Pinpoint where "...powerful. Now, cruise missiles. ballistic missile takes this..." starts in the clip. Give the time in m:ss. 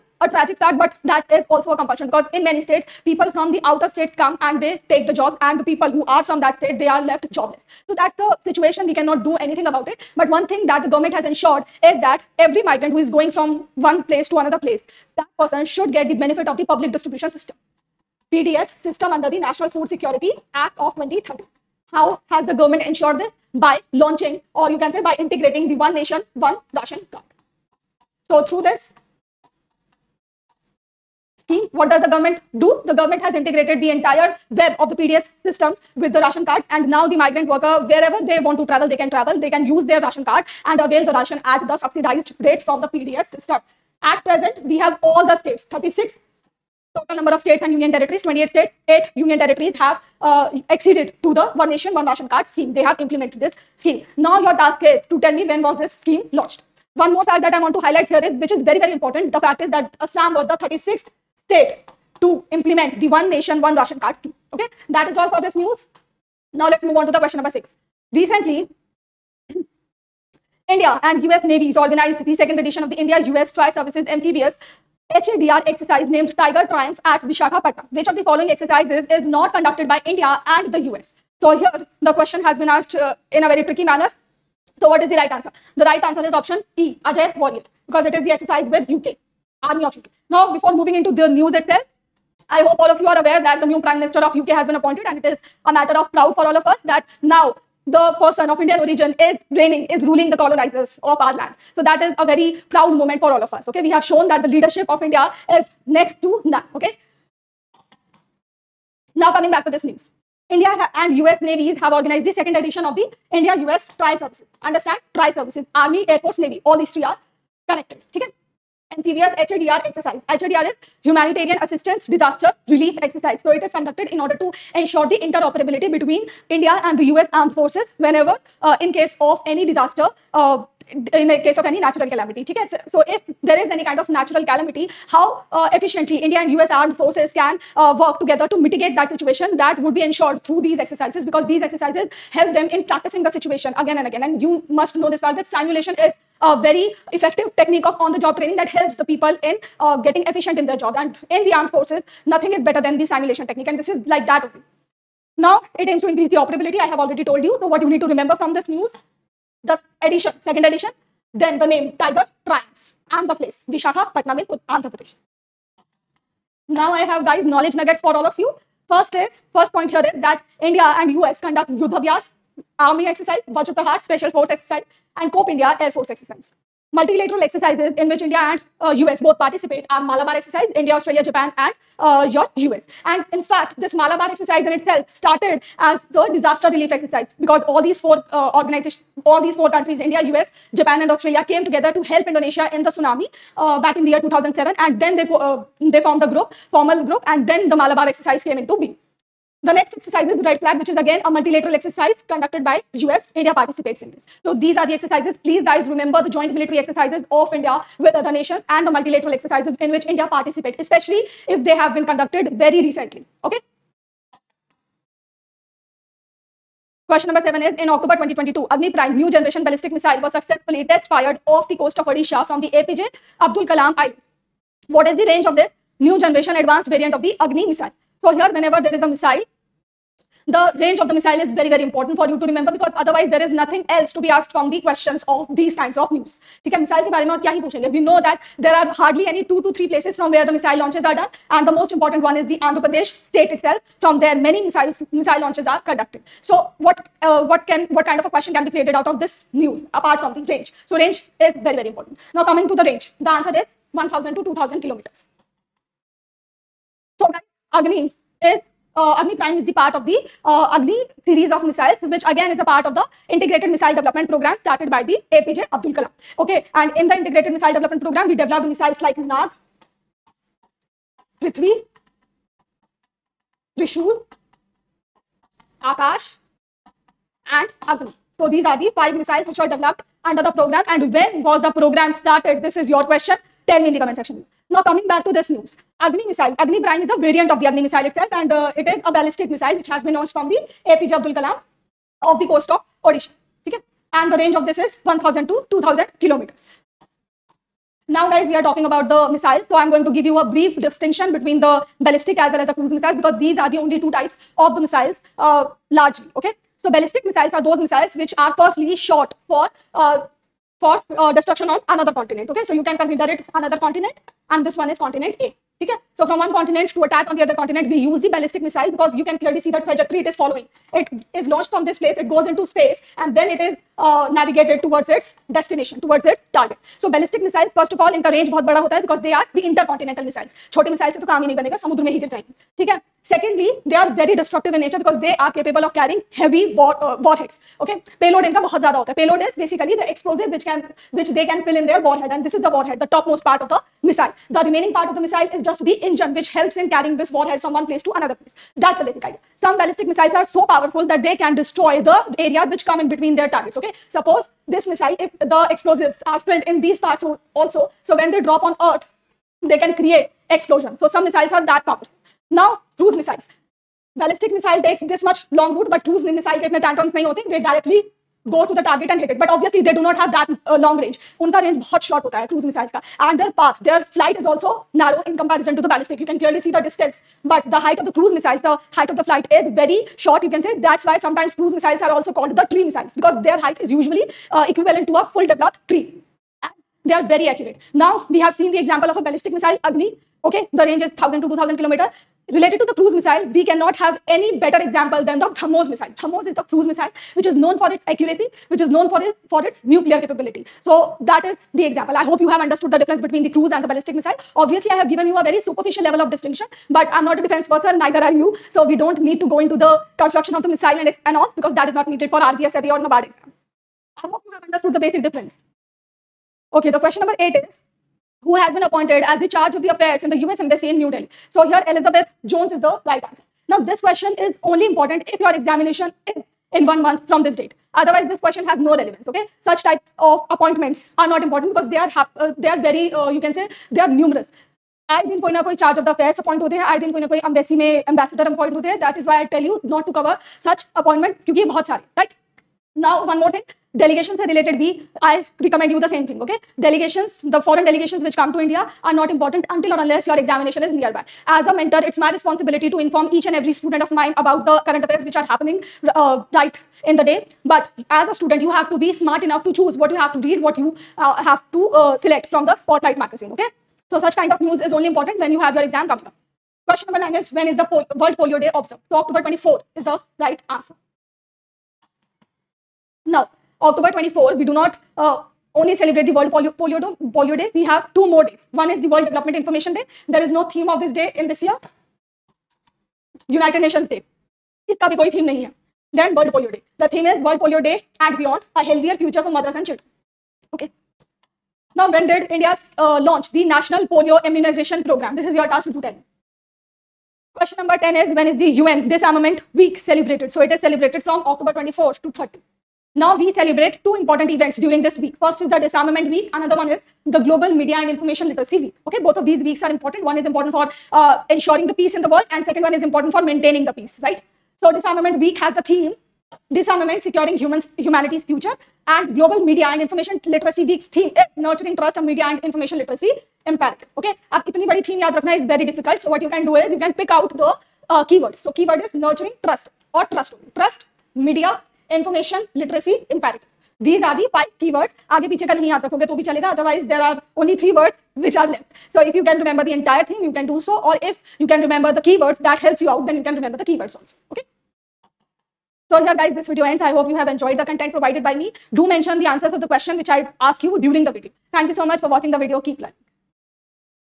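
6:01.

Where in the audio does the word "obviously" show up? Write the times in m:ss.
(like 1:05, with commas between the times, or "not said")
6:09, 6:44.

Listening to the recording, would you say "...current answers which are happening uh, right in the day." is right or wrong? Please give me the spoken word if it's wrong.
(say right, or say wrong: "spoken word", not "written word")
wrong: "affairs", not "answers".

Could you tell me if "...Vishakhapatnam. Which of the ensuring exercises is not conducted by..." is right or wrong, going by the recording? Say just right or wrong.
wrong.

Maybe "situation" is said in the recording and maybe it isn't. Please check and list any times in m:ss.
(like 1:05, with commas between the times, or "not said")
0:08, 2:19, 2:23.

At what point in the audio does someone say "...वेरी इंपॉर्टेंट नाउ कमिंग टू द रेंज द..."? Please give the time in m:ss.
4:11.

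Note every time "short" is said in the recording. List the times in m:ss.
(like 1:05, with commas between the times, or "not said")
6:12, 6:20.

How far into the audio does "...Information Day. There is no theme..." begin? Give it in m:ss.
7:59.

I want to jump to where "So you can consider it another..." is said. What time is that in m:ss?
5:12.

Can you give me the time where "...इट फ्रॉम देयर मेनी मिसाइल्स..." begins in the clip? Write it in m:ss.
4:03.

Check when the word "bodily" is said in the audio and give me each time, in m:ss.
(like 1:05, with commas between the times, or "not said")
not said.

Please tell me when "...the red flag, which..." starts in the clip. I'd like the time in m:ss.
3:20.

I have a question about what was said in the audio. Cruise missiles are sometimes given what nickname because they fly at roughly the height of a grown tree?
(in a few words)
tree missiles.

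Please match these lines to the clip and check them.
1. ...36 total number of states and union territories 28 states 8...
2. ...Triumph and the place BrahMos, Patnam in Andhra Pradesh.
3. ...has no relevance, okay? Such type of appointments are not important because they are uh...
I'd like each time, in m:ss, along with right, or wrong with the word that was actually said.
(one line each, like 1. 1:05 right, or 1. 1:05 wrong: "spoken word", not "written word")
1. 0:45 right
2. 2:42 wrong: "Vishakha", not "BrahMos"
3. 7:08 right.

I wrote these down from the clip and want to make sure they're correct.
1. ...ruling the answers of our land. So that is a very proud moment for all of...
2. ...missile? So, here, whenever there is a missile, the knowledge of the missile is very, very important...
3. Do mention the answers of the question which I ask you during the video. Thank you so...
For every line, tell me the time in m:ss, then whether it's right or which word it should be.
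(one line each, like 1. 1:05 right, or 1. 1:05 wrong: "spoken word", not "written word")
1. 1:40 wrong: "colonizers", not "answers"
2. 3:47 wrong: "range", not "knowledge"
3. 9:08 right.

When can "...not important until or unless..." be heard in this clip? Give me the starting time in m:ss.
7:29.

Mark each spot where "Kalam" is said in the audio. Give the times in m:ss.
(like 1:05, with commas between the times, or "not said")
3:43, 4:51.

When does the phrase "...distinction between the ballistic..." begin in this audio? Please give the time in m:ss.
5:00.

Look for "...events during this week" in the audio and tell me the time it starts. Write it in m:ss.
8:24.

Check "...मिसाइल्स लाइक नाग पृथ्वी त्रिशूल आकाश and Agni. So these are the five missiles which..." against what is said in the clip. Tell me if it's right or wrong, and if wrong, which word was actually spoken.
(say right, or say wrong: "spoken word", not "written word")
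right.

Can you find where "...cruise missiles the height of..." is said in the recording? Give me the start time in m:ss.
6:18.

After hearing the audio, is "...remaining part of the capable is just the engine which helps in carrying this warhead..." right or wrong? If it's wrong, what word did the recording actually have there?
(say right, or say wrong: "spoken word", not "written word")
wrong: "missile", not "capable".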